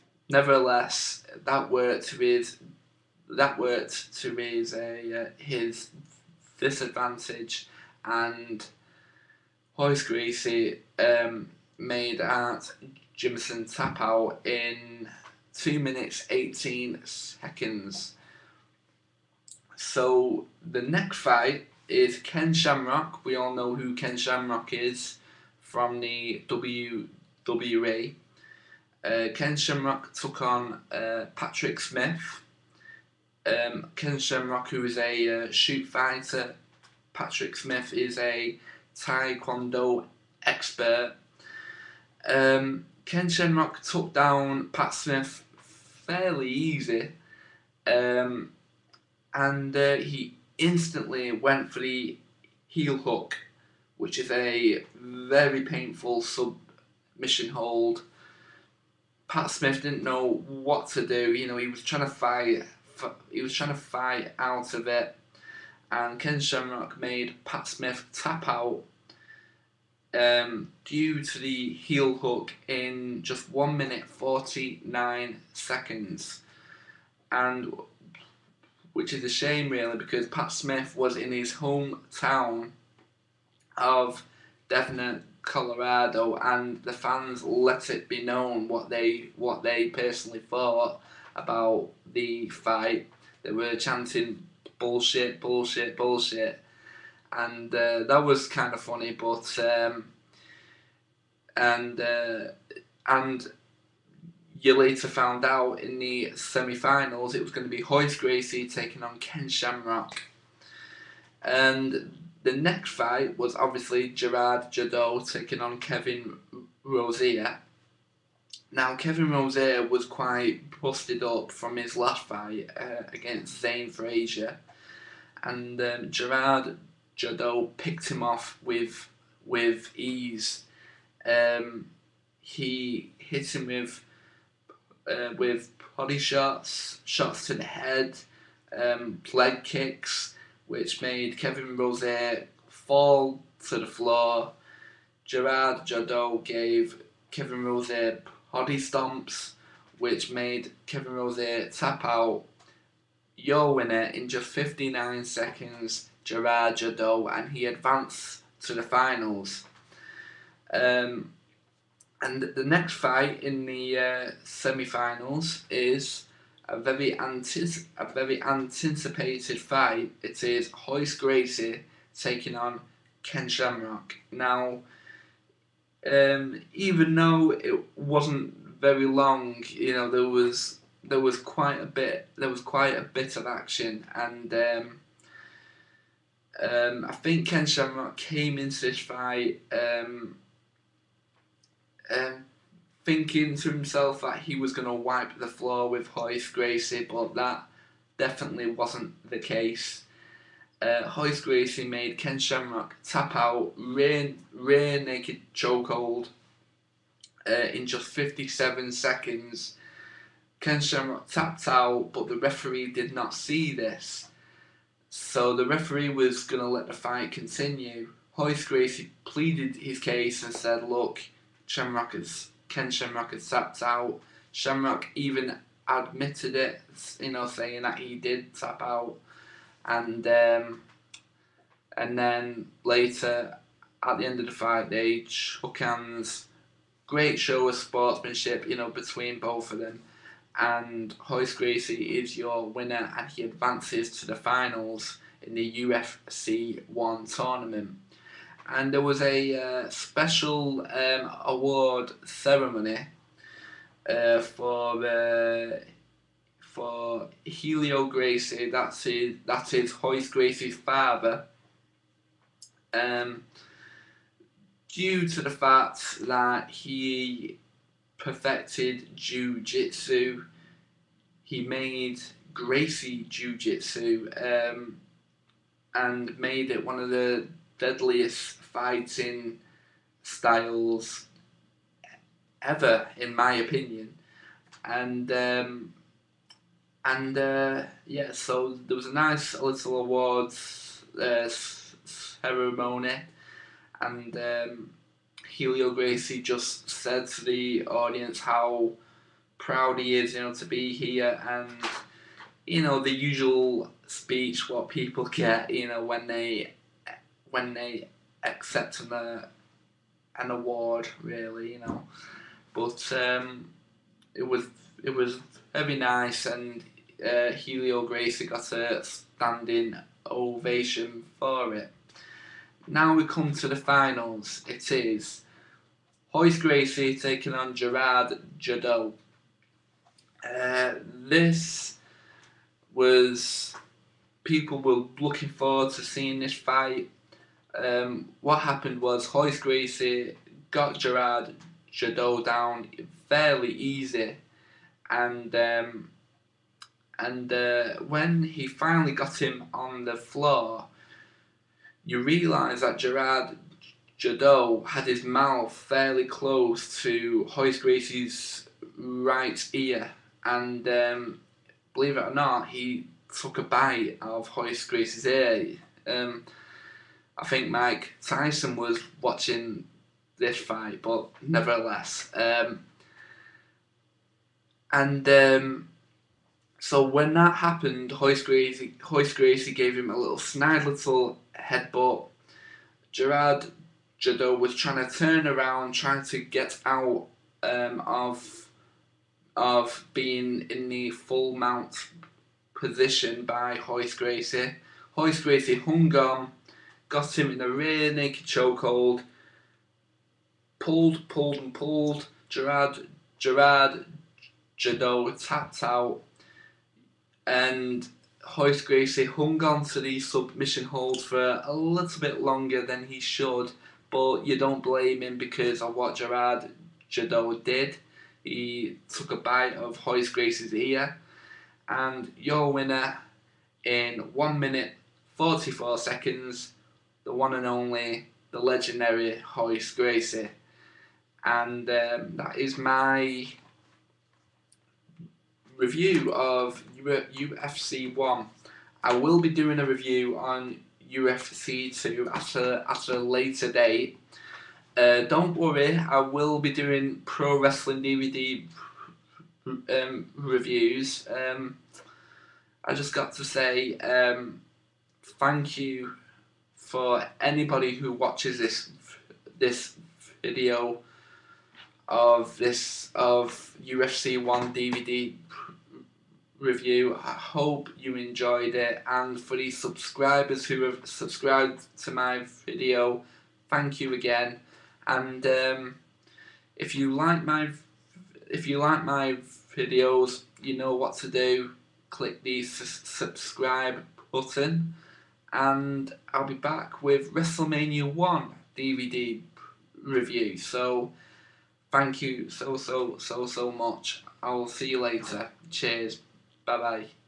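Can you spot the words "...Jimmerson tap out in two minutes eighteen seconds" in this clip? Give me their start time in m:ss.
0:13.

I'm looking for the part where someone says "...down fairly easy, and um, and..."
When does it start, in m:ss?
5:42.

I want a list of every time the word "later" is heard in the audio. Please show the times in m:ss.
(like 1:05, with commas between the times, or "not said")
1:44, 3:52, 7:23, 8:15.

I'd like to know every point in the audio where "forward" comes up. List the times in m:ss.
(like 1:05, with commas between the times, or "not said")
5:35.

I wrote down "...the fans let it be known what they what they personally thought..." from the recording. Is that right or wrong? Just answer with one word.
right.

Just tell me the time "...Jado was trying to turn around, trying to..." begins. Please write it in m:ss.
6:24.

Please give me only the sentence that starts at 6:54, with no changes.
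But you don't blame him because of what Gerard Jadot did.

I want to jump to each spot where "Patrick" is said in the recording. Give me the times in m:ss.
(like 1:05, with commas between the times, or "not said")
0:31, 0:37.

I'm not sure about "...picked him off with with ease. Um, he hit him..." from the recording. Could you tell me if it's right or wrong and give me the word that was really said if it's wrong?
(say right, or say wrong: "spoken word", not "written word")
right.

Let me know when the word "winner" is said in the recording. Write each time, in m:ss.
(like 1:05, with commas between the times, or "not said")
2:33, 4:02, 7:02.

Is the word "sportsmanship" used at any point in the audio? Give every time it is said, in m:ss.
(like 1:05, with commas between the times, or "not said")
3:57.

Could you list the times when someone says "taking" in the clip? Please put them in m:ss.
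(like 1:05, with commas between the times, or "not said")
1:48, 1:55, 2:52, 5:27.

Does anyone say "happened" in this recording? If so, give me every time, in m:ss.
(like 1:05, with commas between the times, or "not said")
5:38, 6:17.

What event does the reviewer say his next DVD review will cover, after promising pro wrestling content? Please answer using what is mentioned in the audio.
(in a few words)
WrestleMania 1.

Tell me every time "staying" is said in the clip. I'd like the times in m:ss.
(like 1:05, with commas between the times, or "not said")
not said.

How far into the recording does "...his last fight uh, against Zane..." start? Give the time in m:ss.
2:01.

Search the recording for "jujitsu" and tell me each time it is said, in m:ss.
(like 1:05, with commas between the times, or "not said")
4:29, 4:33.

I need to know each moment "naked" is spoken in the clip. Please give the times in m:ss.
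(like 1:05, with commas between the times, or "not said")
3:25, 6:38.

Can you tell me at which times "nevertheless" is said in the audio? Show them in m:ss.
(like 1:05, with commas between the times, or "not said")
0:00, 6:11.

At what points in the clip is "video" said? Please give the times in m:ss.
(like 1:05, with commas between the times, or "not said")
7:40, 7:52, 7:59.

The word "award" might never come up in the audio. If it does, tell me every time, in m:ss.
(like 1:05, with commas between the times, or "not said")
4:11, 4:50, 5:10.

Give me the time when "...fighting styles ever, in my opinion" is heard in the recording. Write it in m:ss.
4:38.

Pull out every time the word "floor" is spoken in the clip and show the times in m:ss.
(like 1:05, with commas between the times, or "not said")
2:23, 3:15, 5:50.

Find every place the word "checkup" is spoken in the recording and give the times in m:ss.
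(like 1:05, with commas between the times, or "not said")
not said.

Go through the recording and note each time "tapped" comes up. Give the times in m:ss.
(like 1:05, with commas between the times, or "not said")
3:31, 3:43, 6:45.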